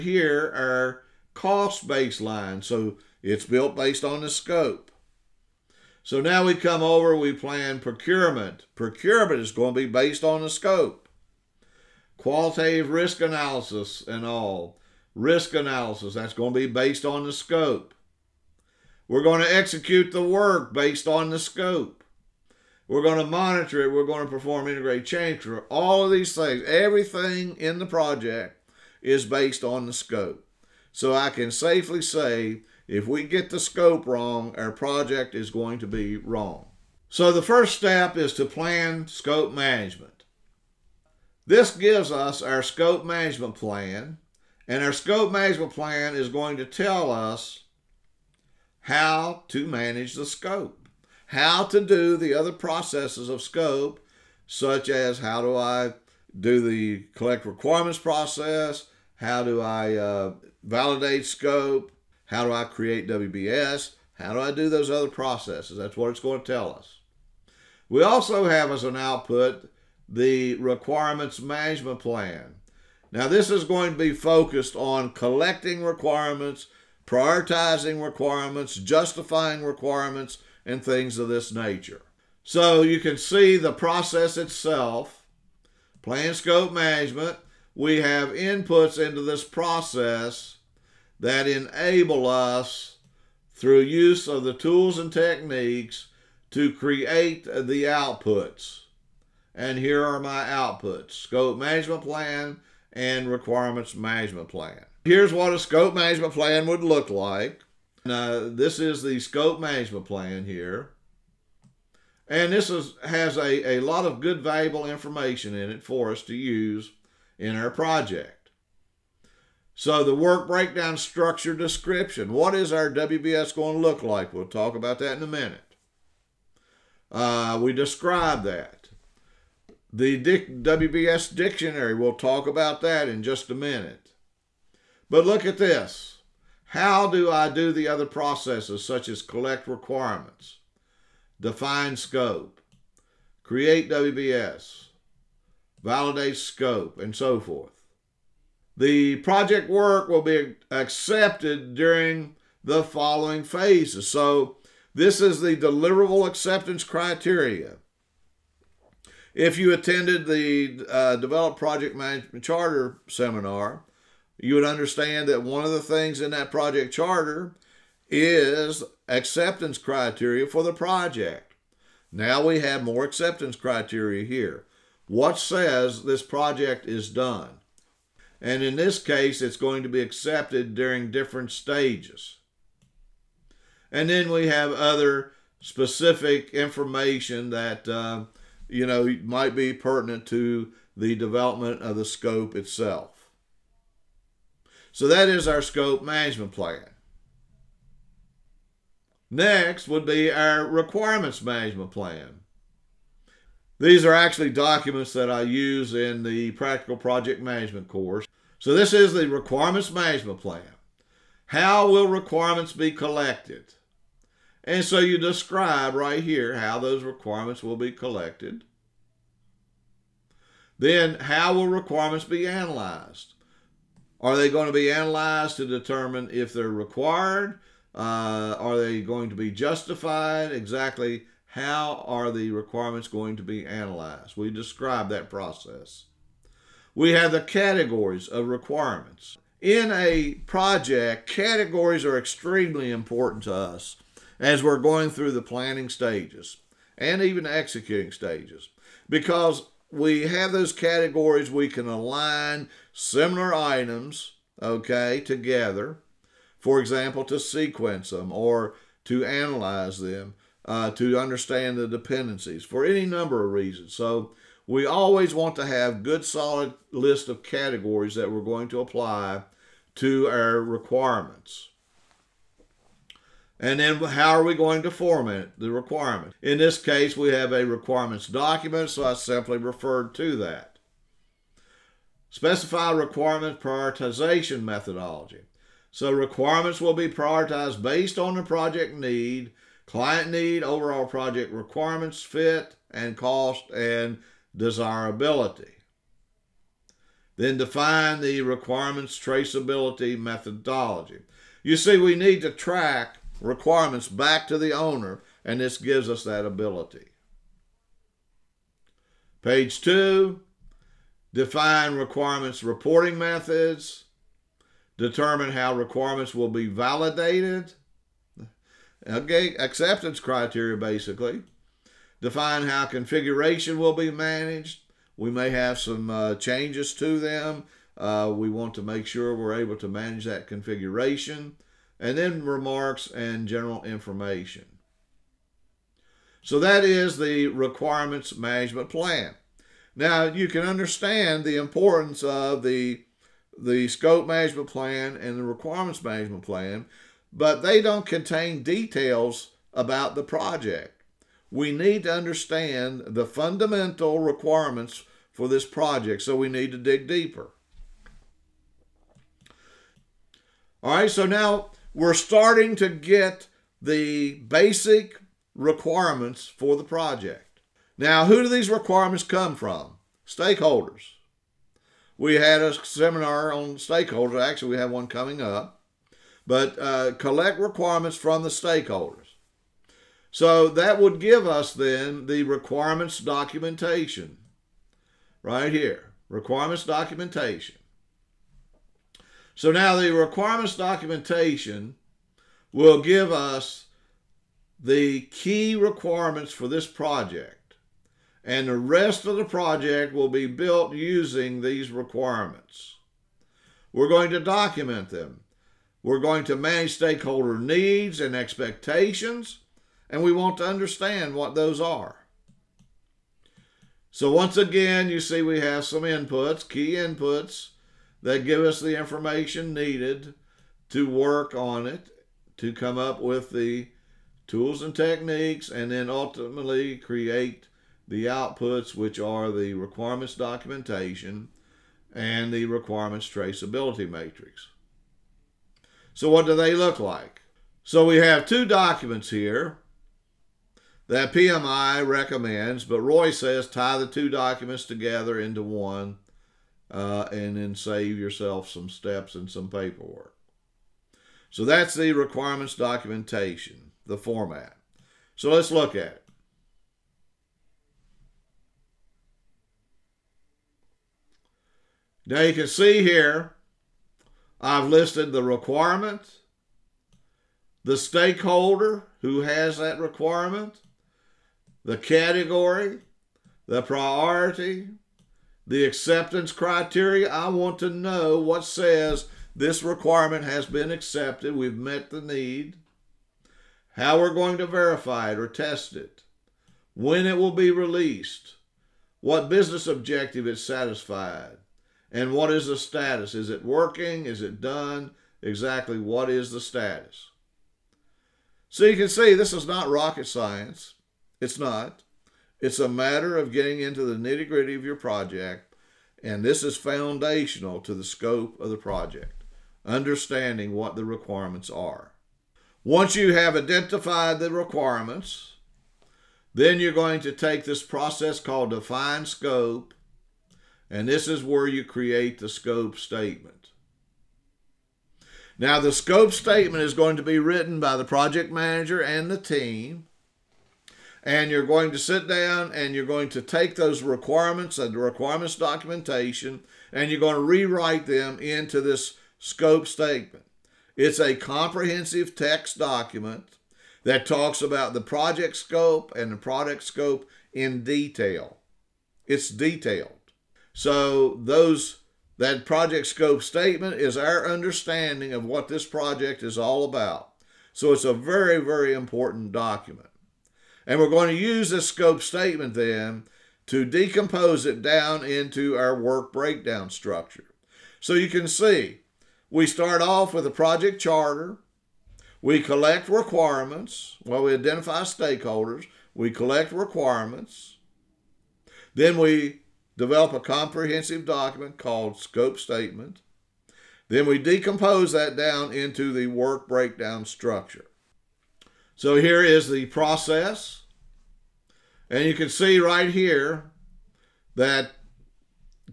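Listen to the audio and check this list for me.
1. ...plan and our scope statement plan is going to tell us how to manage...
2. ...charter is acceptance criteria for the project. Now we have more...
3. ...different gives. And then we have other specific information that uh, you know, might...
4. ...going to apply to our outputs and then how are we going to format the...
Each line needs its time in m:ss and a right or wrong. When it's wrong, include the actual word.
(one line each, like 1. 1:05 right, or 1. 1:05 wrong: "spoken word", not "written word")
1. 0:43 wrong: "management", not "statement"
2. 2:46 right
3. 3:01 wrong: "stages", not "gives"
4. 4:28 wrong: "requirements", not "outputs".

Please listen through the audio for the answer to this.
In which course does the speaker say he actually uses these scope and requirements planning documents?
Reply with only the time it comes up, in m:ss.
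3:26.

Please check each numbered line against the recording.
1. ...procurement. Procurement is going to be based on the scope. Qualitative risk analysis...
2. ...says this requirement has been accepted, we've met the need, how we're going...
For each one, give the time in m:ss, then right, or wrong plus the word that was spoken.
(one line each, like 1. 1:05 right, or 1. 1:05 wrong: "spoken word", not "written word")
1. 0:07 right
2. 7:58 right.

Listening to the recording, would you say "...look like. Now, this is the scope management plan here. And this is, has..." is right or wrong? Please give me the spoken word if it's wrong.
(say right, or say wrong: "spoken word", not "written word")
right.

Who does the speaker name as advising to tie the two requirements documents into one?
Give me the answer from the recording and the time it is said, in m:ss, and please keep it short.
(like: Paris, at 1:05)
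Roy, at 7:22.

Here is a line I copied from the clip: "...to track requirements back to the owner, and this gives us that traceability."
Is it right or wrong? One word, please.
wrong.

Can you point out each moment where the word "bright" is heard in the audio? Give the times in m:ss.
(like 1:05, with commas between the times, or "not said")
not said.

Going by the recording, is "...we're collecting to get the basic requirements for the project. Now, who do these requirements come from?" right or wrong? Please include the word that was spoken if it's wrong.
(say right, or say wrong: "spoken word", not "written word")
wrong: "starting", not "collecting".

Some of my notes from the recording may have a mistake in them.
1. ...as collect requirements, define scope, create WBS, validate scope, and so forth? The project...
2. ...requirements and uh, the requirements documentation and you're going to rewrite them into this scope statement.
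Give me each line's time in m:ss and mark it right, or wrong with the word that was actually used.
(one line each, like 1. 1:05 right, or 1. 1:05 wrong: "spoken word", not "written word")
1. 2:19 right
2. 8:54 right.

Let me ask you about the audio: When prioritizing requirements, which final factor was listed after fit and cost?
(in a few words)
Desirability.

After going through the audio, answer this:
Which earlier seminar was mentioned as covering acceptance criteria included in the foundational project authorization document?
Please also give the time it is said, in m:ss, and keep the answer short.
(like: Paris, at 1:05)
Develop Project Management Charter, at 2:41.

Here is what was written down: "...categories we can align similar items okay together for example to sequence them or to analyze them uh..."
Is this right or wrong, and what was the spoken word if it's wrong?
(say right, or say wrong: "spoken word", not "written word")
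right.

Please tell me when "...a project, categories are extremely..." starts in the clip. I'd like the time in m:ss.
3:59.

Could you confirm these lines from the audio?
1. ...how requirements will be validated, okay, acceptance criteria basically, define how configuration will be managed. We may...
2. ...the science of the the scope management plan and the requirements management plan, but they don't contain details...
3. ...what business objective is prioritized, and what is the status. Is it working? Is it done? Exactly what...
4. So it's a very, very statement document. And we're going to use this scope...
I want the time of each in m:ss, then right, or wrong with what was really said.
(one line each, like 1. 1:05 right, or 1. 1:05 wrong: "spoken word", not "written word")
1. 5:15 right
2. 5:41 wrong: "importance", not "science"
3. 8:09 wrong: "satisfied", not "prioritized"
4. 9:17 wrong: "important", not "statement".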